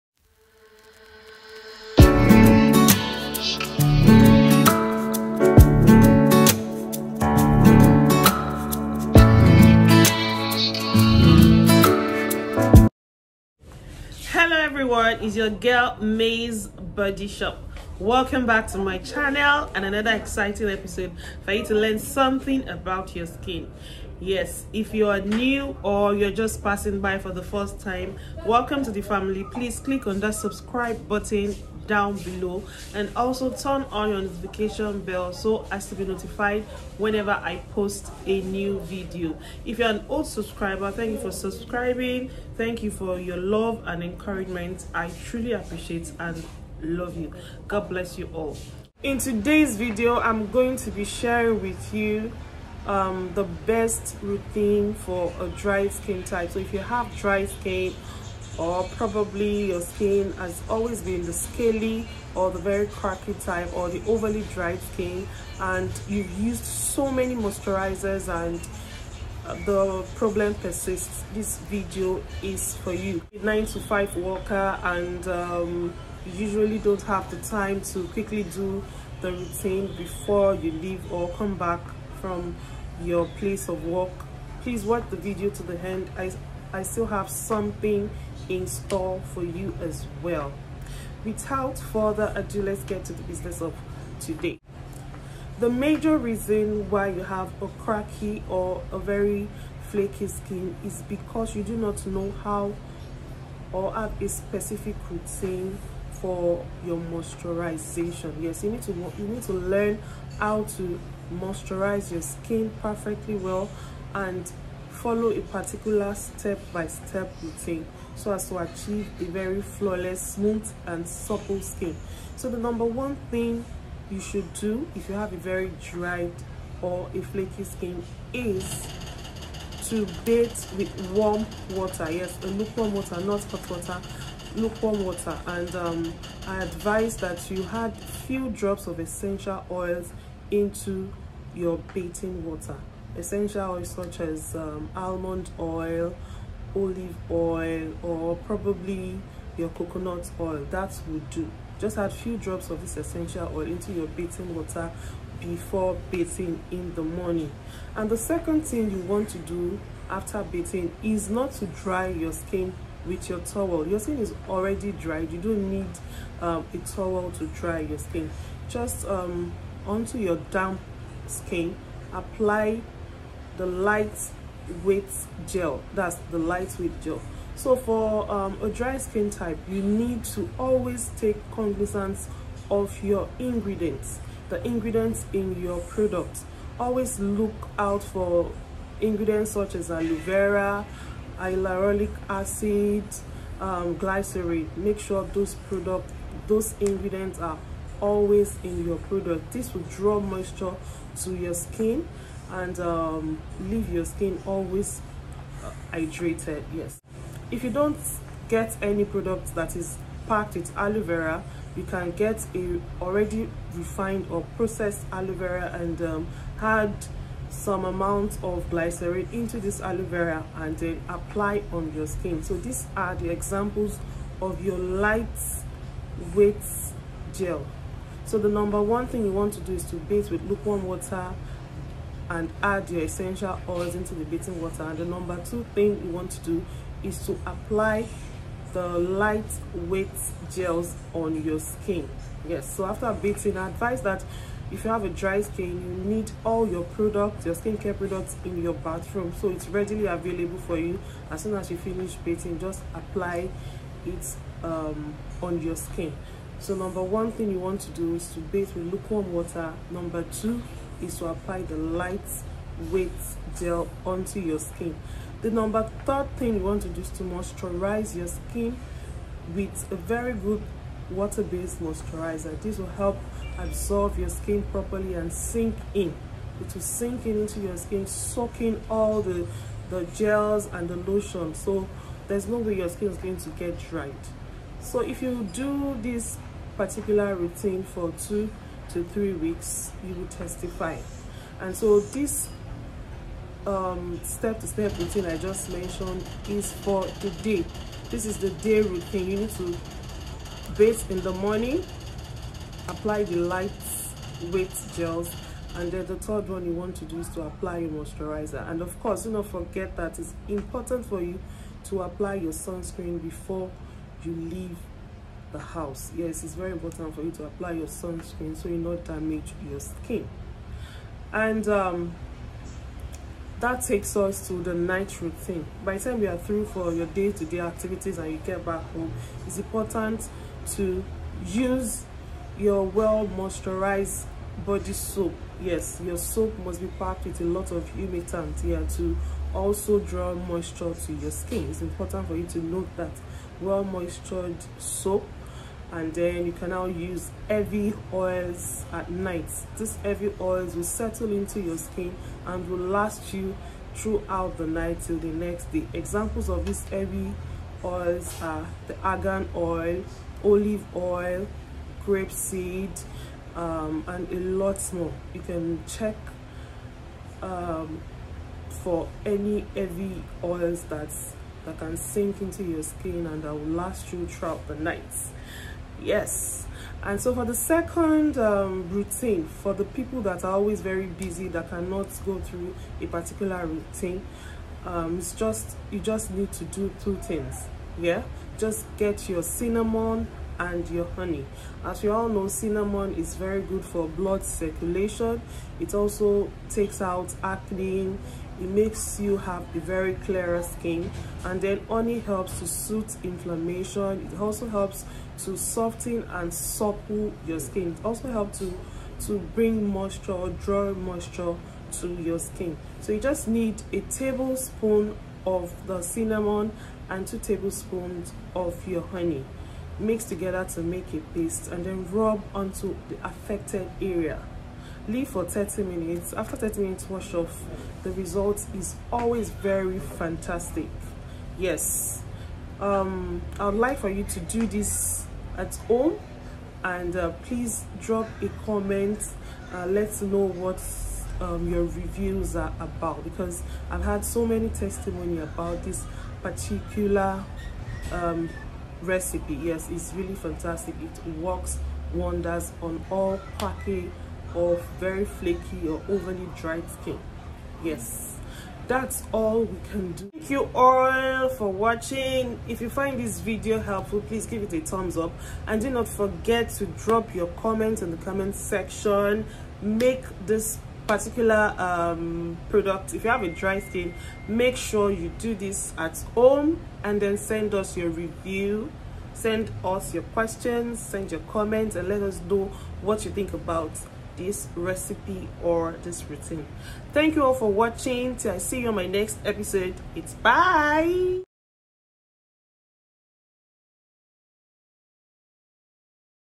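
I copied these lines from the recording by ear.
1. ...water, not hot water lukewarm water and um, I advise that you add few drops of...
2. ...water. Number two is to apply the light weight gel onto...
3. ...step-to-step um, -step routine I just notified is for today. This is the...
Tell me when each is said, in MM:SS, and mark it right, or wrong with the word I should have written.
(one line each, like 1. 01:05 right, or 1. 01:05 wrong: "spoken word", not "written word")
1. 02:12 right
2. 04:19 right
3. 04:54 wrong: "mentioned", not "notified".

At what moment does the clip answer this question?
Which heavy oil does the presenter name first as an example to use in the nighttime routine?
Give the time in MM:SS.
05:58.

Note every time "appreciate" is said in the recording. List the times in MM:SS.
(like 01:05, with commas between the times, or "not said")
00:45.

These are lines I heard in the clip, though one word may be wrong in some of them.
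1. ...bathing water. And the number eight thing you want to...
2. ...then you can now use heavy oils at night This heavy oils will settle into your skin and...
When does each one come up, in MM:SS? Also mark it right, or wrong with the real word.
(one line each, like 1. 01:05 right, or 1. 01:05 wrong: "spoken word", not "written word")
1. 03:54 wrong: "two", not "eight"
2. 05:46 right.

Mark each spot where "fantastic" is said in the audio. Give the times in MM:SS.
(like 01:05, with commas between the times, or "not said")
07:09, 07:30.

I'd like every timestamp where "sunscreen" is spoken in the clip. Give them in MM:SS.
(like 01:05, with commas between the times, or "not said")
05:12, 05:17.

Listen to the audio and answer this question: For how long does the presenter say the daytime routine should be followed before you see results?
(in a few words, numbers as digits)
2 to 3 weeks.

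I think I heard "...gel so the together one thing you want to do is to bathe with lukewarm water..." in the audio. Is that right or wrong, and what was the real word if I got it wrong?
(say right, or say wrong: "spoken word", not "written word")
wrong: "number", not "together".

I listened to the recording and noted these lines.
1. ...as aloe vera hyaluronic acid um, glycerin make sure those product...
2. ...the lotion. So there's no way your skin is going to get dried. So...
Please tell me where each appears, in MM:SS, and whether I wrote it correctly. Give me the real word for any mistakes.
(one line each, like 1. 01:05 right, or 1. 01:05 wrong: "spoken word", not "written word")
1. 03:09 right
2. 04:40 right.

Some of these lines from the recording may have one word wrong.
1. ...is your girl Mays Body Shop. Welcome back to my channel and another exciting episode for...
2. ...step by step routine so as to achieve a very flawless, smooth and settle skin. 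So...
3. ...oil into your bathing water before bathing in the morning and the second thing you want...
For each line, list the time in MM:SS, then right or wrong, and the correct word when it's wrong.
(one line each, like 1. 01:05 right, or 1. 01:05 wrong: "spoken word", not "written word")
1. 00:15 right
2. 01:56 wrong: "supple", not "settle"
3. 02:33 right.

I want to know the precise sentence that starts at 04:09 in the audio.
So it's readily available for you.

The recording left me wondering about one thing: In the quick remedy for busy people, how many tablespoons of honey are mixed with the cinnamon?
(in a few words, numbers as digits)
2 tablespoons.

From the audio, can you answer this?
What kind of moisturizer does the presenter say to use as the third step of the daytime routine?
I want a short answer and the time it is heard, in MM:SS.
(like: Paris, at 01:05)
Water-based moisturizer, at 04:31.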